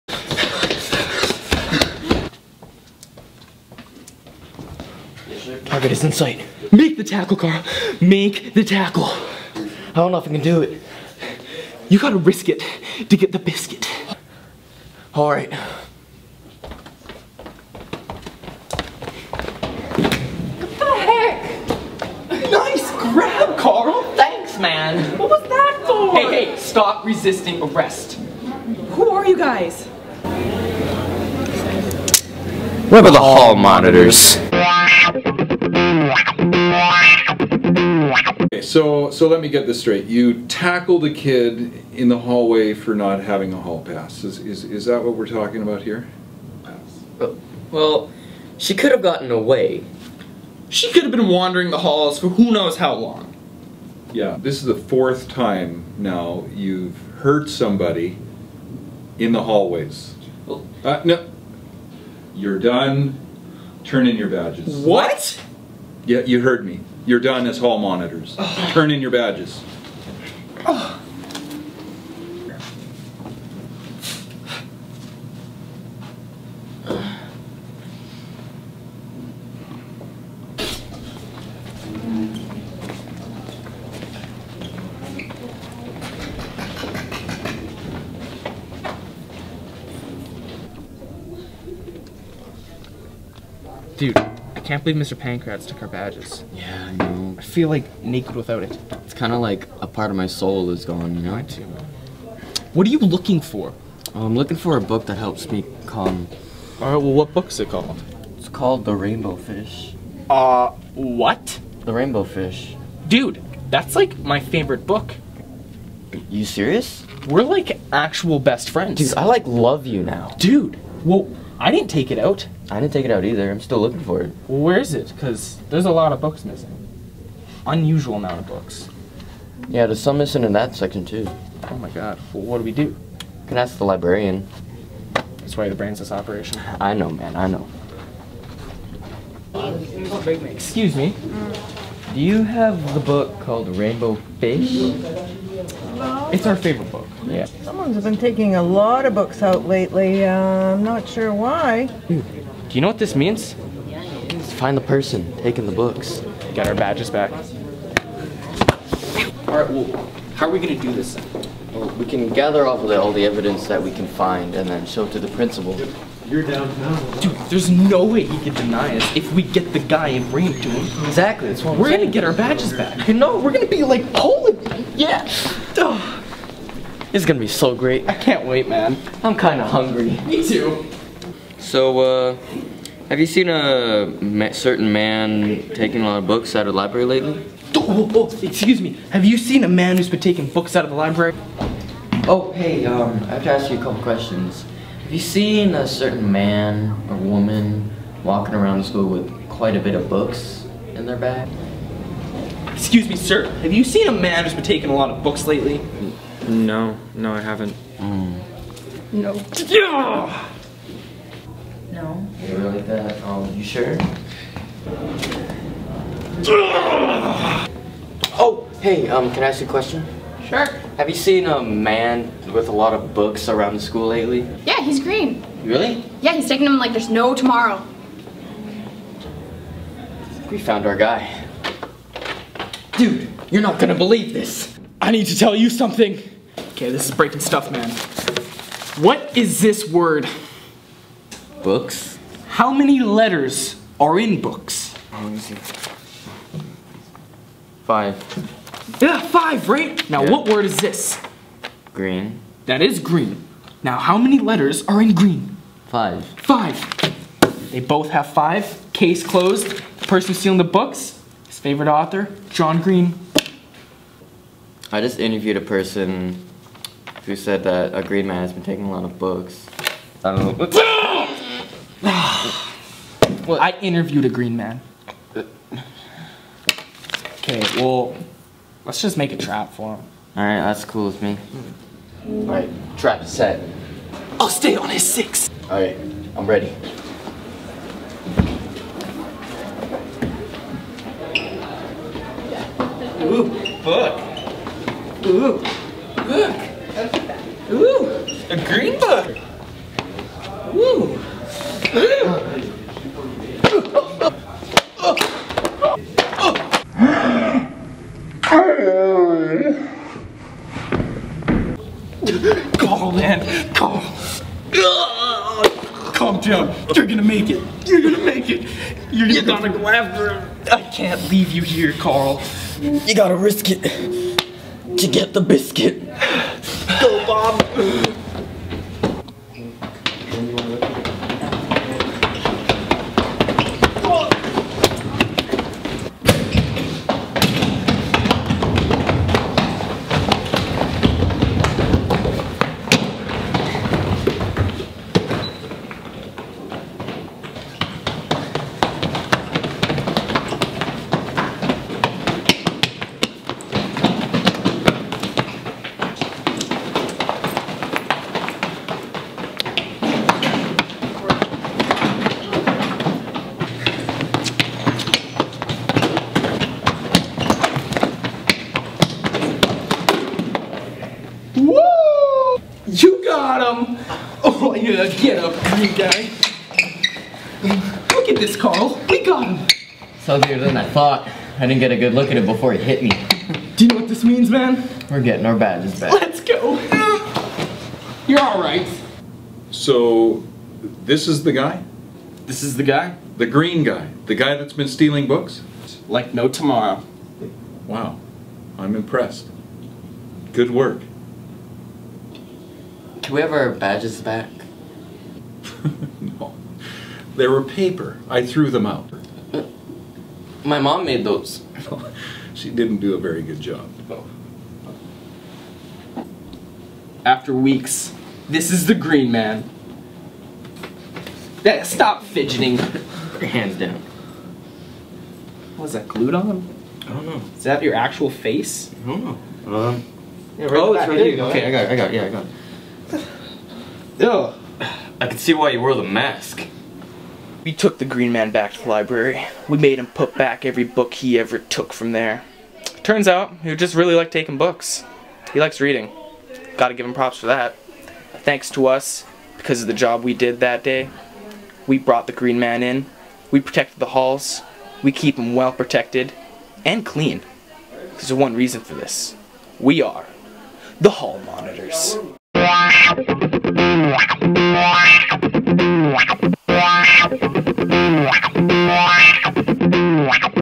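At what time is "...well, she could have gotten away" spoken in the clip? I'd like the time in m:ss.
0:47.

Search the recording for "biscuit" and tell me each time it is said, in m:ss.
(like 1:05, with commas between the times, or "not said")
0:13, 5:25.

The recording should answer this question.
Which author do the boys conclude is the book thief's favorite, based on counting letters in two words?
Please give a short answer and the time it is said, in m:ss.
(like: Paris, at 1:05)
John Green, at 4:22.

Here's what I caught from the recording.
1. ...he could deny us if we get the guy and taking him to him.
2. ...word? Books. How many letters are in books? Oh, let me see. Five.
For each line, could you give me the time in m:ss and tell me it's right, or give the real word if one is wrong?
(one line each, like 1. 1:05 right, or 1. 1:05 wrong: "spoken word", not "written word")
1. 2:48 wrong: "bring", not "taking"
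2. 3:59 right.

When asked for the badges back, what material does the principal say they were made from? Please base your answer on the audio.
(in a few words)
Paper.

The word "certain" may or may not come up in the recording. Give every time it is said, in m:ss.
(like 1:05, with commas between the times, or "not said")
3:04, 3:15.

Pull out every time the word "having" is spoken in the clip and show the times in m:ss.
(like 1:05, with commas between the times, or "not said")
0:43.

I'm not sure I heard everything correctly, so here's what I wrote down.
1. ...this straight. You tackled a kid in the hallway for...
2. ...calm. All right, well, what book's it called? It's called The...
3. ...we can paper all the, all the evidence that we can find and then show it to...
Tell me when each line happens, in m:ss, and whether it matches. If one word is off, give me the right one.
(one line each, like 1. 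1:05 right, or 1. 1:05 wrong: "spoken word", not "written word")
1. 0:39 right
2. 1:45 right
3. 2:41 wrong: "gather", not "paper".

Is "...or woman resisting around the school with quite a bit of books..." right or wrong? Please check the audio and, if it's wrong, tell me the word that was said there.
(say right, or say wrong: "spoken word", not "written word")
wrong: "walking", not "resisting".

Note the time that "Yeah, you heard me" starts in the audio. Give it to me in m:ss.
1:06.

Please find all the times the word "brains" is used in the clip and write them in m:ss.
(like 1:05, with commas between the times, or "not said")
2:15.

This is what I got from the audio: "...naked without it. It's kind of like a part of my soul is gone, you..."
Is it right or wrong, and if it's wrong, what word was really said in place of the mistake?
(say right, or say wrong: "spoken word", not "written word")
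right.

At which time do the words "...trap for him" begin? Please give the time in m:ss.
4:39.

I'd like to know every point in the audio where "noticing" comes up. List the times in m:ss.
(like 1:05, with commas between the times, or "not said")
not said.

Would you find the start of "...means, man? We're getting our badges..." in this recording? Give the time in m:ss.
6:24.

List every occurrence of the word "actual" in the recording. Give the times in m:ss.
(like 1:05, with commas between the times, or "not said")
1:57, 7:07.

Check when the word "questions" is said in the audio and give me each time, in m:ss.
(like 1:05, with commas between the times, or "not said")
3:14, 3:39.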